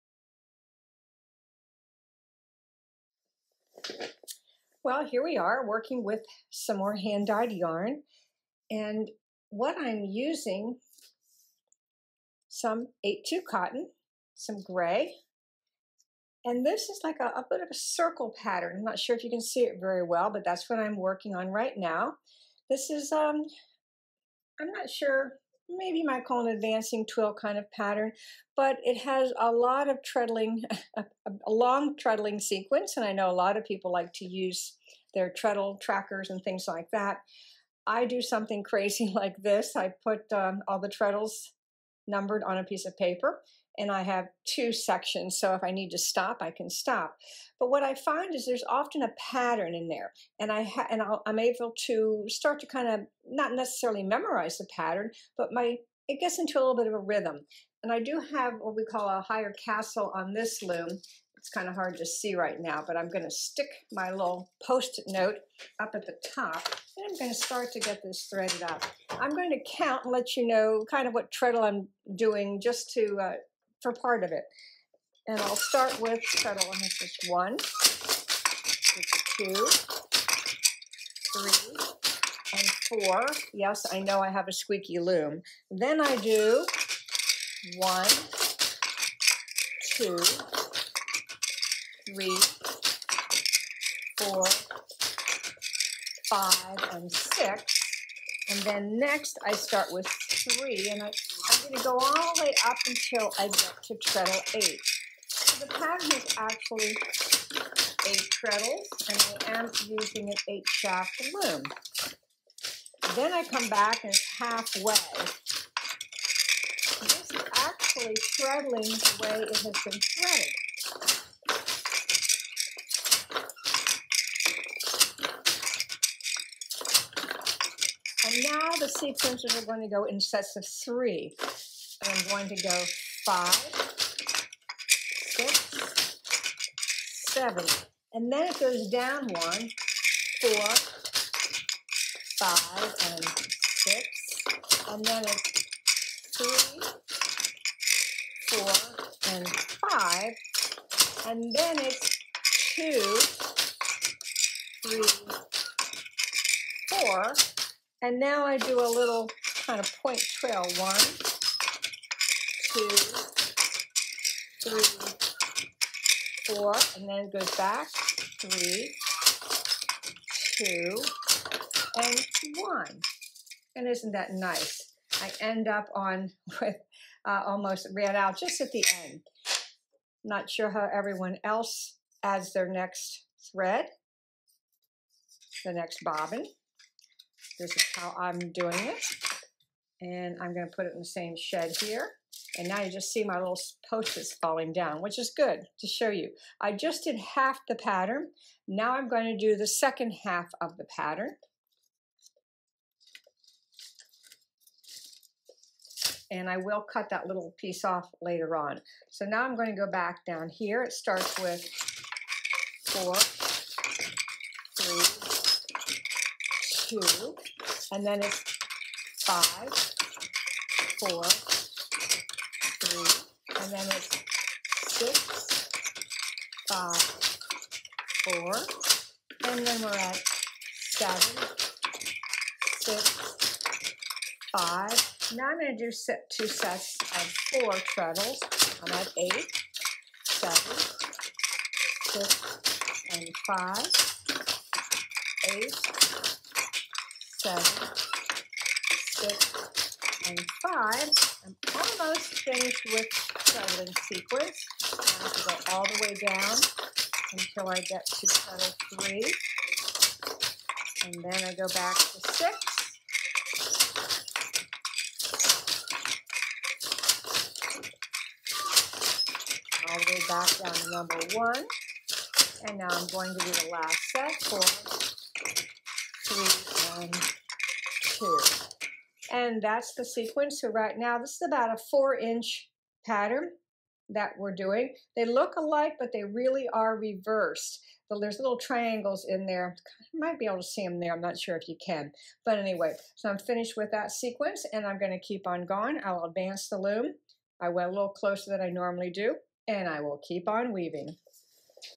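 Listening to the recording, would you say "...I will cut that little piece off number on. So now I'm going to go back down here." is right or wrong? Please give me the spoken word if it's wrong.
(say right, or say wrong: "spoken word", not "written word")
wrong: "later", not "number".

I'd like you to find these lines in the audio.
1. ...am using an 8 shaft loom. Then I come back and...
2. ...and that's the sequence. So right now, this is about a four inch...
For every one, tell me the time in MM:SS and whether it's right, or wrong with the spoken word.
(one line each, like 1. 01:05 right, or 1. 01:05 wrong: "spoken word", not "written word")
1. 01:49 right
2. 04:39 right.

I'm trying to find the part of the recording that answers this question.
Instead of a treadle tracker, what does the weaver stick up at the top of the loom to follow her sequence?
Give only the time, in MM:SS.
01:04.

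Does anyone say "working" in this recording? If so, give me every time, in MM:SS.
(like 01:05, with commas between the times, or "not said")
00:05, 00:20.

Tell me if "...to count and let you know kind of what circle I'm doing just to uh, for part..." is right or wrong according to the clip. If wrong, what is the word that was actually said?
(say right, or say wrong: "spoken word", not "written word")
wrong: "treadle", not "circle".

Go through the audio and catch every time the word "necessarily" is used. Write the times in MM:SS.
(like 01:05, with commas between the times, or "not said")
00:53.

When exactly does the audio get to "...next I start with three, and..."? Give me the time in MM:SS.
01:38.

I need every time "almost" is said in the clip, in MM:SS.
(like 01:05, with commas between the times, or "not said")
02:57, 04:11.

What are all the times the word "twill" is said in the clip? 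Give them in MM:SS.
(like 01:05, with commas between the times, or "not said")
00:27, 02:40.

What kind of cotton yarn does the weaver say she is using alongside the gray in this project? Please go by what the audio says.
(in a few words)
8/2 cotton.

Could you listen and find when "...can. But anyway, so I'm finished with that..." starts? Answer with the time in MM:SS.
04:51.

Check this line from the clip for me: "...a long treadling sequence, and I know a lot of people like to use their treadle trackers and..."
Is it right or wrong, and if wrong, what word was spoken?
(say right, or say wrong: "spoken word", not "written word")
right.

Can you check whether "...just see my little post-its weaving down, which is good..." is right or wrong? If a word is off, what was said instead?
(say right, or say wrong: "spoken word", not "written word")
wrong: "falling", not "weaving".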